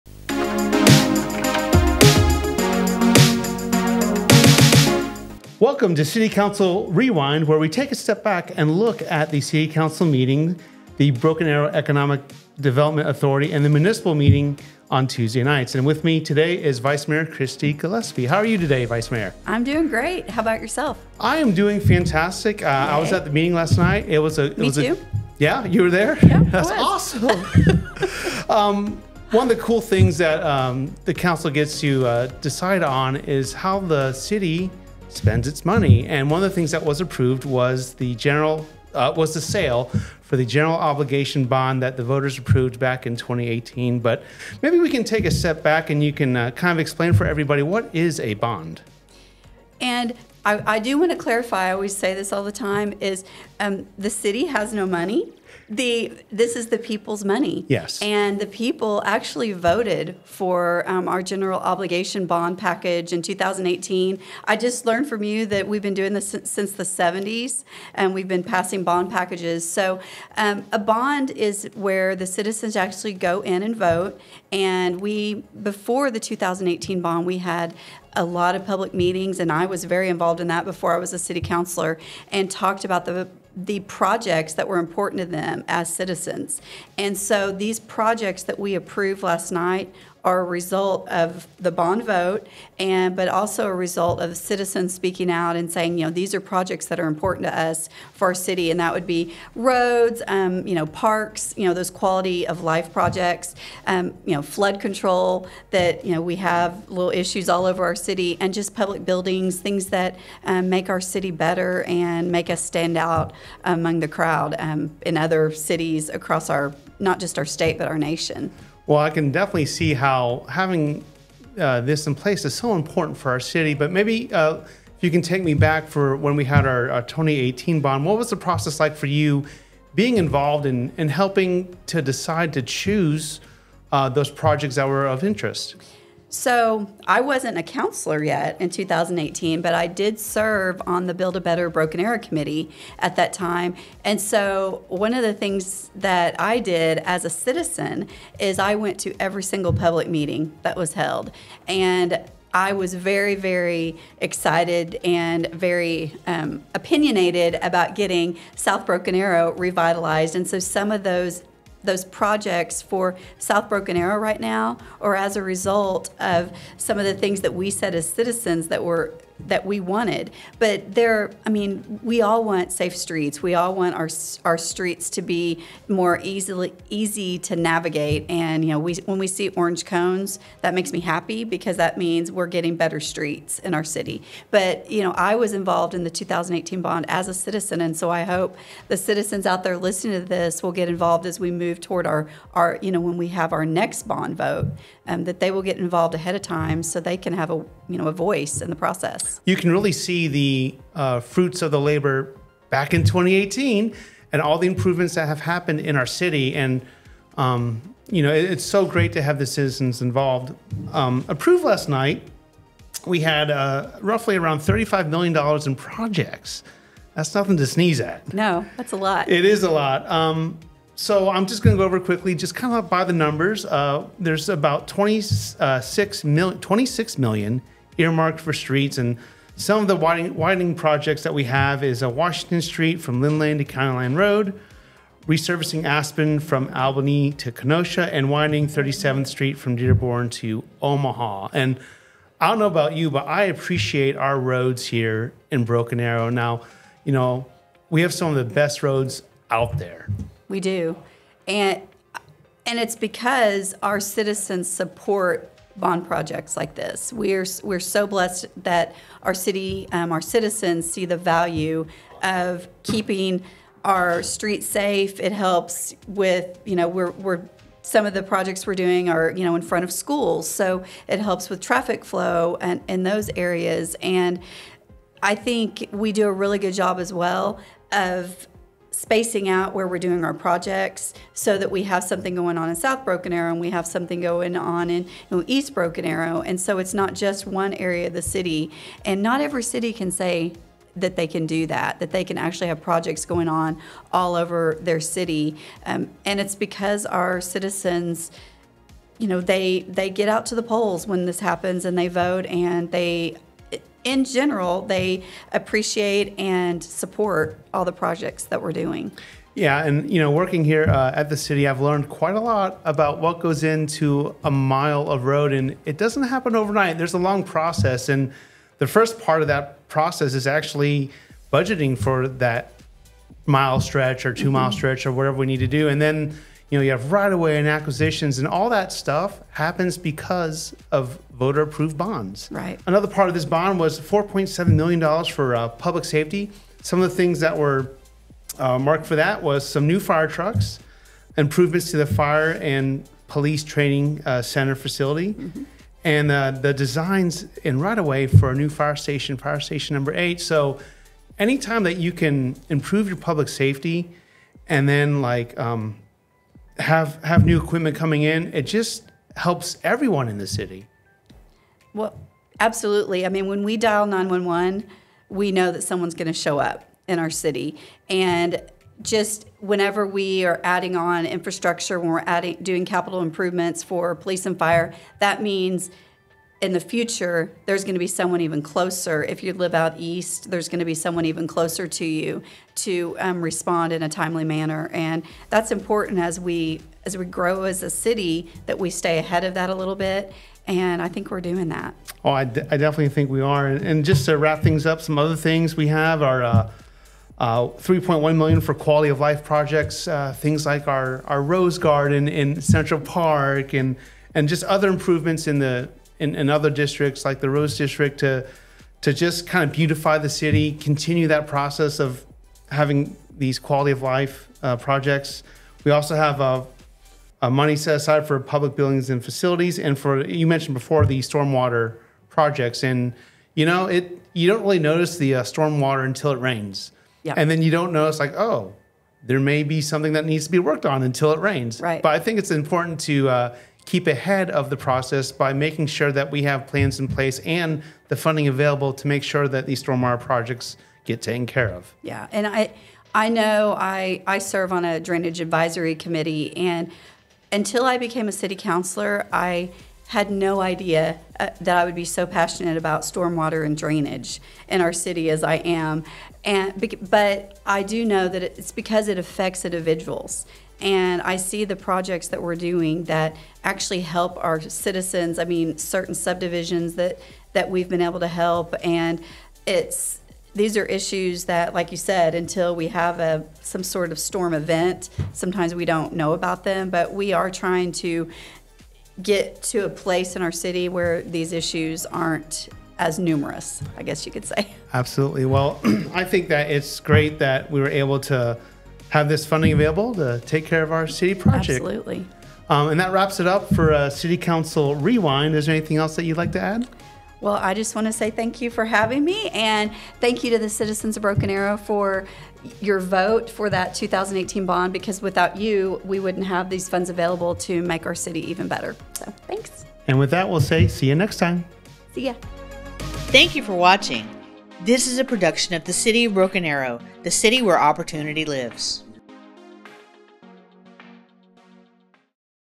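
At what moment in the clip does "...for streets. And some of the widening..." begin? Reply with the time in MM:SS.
03:48.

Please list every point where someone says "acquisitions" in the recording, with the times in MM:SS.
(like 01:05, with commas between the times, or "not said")
05:27.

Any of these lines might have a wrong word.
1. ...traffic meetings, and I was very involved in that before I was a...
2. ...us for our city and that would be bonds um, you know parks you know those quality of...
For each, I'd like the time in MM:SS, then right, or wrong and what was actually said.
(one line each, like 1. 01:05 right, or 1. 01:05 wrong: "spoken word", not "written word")
1. 01:18 wrong: "public", not "traffic"
2. 01:37 wrong: "roads", not "bonds".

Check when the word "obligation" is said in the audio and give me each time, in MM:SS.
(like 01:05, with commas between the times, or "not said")
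00:40, 01:01.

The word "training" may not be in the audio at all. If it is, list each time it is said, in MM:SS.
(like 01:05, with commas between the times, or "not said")
05:43.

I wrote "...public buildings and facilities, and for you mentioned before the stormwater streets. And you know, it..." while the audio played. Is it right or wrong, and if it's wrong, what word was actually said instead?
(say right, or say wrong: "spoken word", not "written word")
wrong: "projects", not "streets".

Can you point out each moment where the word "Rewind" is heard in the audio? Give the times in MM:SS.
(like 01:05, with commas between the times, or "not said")
00:06, 08:14.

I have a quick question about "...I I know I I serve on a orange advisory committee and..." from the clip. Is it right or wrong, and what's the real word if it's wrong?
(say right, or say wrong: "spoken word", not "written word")
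wrong: "drainage", not "orange".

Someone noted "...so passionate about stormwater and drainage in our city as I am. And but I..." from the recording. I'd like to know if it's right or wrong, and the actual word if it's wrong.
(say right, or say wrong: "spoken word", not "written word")
right.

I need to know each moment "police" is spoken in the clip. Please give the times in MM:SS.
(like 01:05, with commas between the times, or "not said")
05:43, 06:14.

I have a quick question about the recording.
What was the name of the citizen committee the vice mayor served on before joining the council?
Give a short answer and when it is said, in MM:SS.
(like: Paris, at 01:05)
Build a Better Broken Arrow Committee, at 02:21.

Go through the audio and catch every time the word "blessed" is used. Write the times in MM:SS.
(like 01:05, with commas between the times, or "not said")
04:18.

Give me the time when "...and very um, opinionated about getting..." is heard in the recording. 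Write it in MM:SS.
02:35.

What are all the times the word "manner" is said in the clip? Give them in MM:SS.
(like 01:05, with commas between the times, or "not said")
06:24.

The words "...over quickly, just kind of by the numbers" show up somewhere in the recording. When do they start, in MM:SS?
03:41.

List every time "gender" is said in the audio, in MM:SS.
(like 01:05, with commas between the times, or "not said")
not said.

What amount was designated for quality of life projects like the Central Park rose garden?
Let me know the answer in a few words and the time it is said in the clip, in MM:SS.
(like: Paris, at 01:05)
3.1 million, at 06:37.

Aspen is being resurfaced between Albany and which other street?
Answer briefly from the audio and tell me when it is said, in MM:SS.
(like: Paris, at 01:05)
Kenosha, at 03:57.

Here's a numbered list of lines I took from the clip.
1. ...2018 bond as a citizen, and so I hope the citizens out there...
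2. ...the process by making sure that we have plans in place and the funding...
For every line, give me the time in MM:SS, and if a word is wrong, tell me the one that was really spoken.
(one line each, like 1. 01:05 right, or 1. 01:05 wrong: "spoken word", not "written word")
1. 03:06 right
2. 07:14 right.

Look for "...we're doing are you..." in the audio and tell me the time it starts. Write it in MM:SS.
04:28.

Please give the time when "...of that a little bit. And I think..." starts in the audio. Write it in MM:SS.
06:29.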